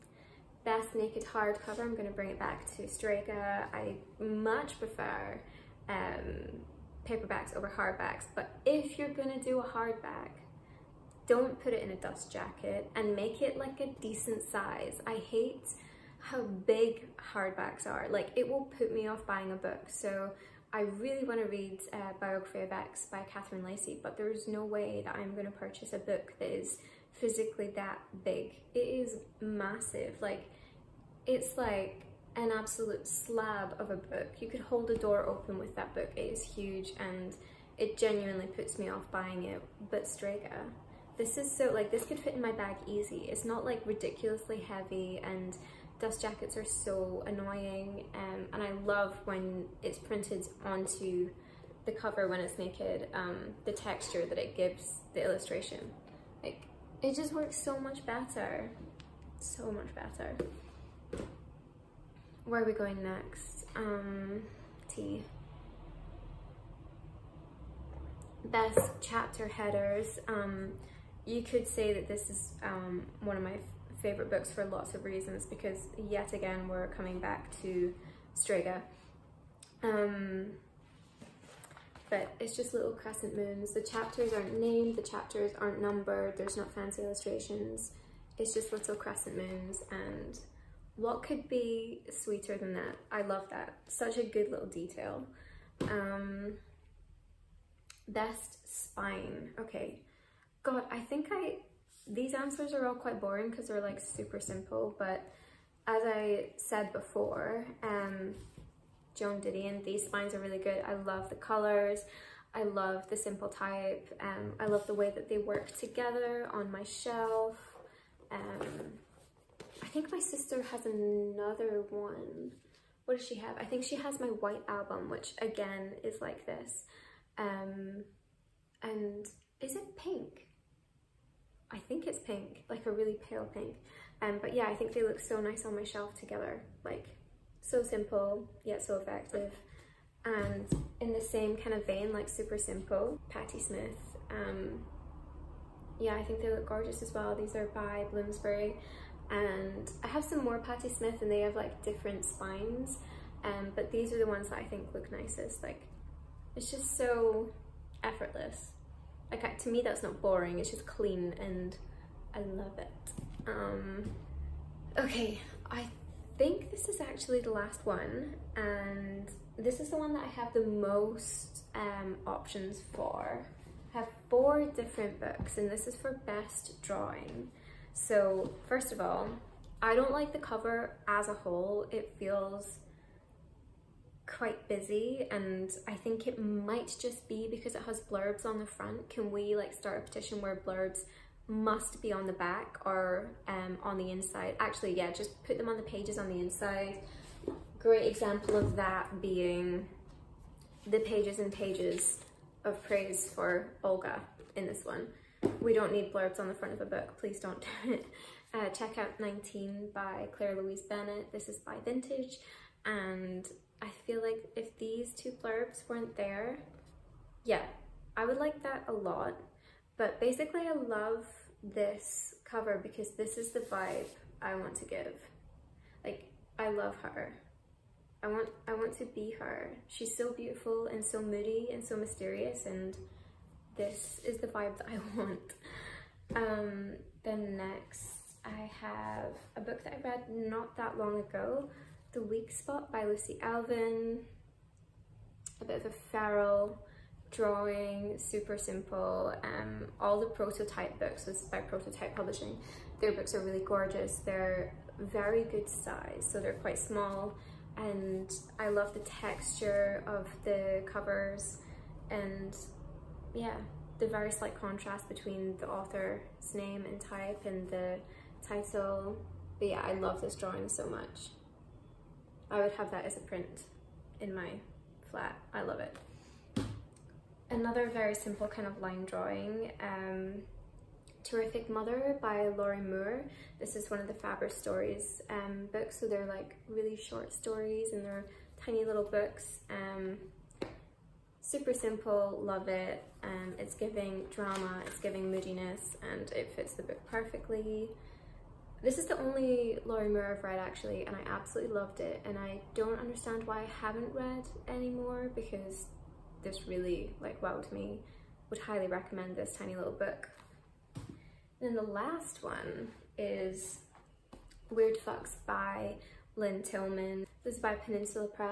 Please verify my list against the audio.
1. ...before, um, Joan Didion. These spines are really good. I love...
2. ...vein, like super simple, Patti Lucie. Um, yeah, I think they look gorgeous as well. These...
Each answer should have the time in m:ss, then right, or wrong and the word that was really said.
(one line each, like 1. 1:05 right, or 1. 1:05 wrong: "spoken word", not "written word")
1. 1:46 right
2. 2:21 wrong: "Smith", not "Lucie".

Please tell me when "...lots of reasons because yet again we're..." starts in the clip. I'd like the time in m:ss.
1:14.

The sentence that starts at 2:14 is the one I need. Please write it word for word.
Um, but yeah, I think they look so nice on my shelf together.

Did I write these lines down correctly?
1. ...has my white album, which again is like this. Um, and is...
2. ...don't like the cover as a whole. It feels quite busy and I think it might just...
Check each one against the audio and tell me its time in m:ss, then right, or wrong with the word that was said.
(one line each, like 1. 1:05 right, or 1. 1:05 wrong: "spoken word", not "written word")
1. 2:03 right
2. 2:59 right.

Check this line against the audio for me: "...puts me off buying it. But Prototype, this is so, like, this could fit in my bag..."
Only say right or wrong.
wrong.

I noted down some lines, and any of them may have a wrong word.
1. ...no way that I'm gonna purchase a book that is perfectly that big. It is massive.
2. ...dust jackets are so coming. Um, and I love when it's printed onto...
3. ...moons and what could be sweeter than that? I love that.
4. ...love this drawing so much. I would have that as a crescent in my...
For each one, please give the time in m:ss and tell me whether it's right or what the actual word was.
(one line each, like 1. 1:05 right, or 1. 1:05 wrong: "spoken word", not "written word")
1. 0:24 wrong: "physically", not "perfectly"
2. 0:45 wrong: "annoying", not "coming"
3. 1:29 right
4. 4:29 wrong: "print", not "crescent".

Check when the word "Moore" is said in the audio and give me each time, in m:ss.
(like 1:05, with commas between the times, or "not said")
4:42, 5:00.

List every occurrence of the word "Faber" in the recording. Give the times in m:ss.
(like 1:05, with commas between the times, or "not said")
4:44.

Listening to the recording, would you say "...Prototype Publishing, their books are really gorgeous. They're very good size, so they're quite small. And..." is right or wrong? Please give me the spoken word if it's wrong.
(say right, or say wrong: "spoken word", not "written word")
right.